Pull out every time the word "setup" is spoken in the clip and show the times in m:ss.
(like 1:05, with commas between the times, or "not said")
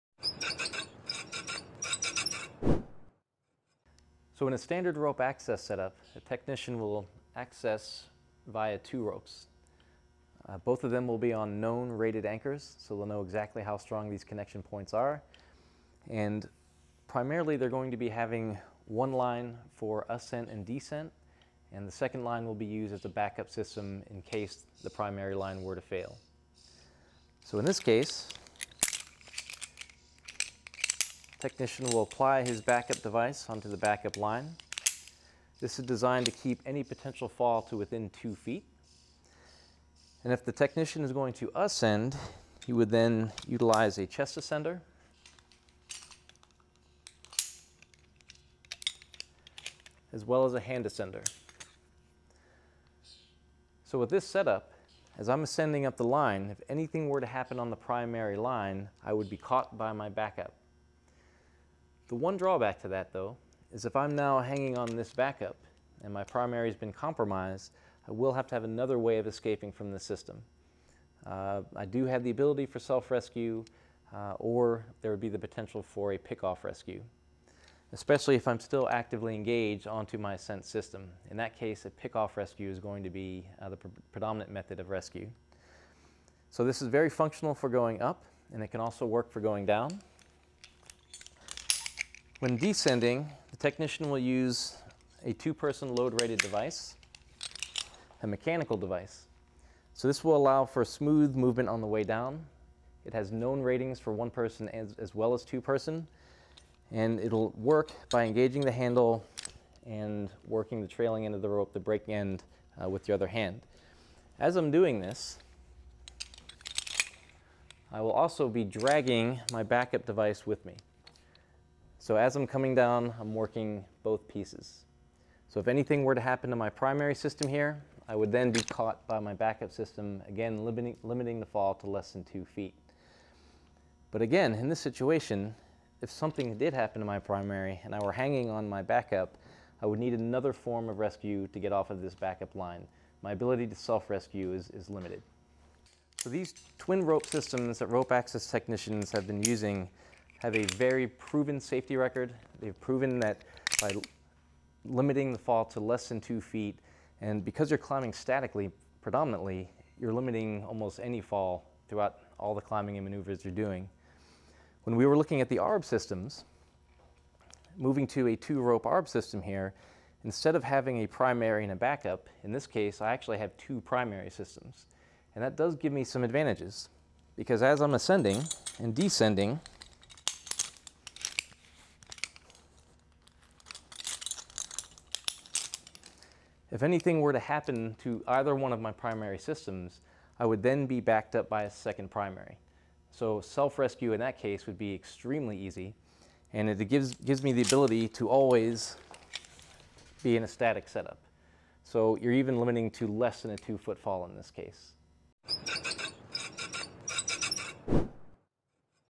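0:05, 0:54, 3:20.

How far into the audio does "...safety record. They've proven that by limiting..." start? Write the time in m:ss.
2:31.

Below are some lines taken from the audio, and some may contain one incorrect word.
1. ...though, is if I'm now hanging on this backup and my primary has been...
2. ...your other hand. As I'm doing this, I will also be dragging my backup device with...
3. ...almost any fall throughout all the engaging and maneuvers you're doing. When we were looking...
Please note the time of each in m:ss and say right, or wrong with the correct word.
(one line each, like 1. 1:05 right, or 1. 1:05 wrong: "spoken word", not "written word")
1. 1:03 right
2. 1:53 right
3. 2:40 wrong: "climbing", not "engaging".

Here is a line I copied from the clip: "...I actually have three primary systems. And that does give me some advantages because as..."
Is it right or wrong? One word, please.
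wrong.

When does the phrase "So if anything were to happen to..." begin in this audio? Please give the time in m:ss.
2:05.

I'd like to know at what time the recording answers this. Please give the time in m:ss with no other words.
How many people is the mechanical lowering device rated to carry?
1:35.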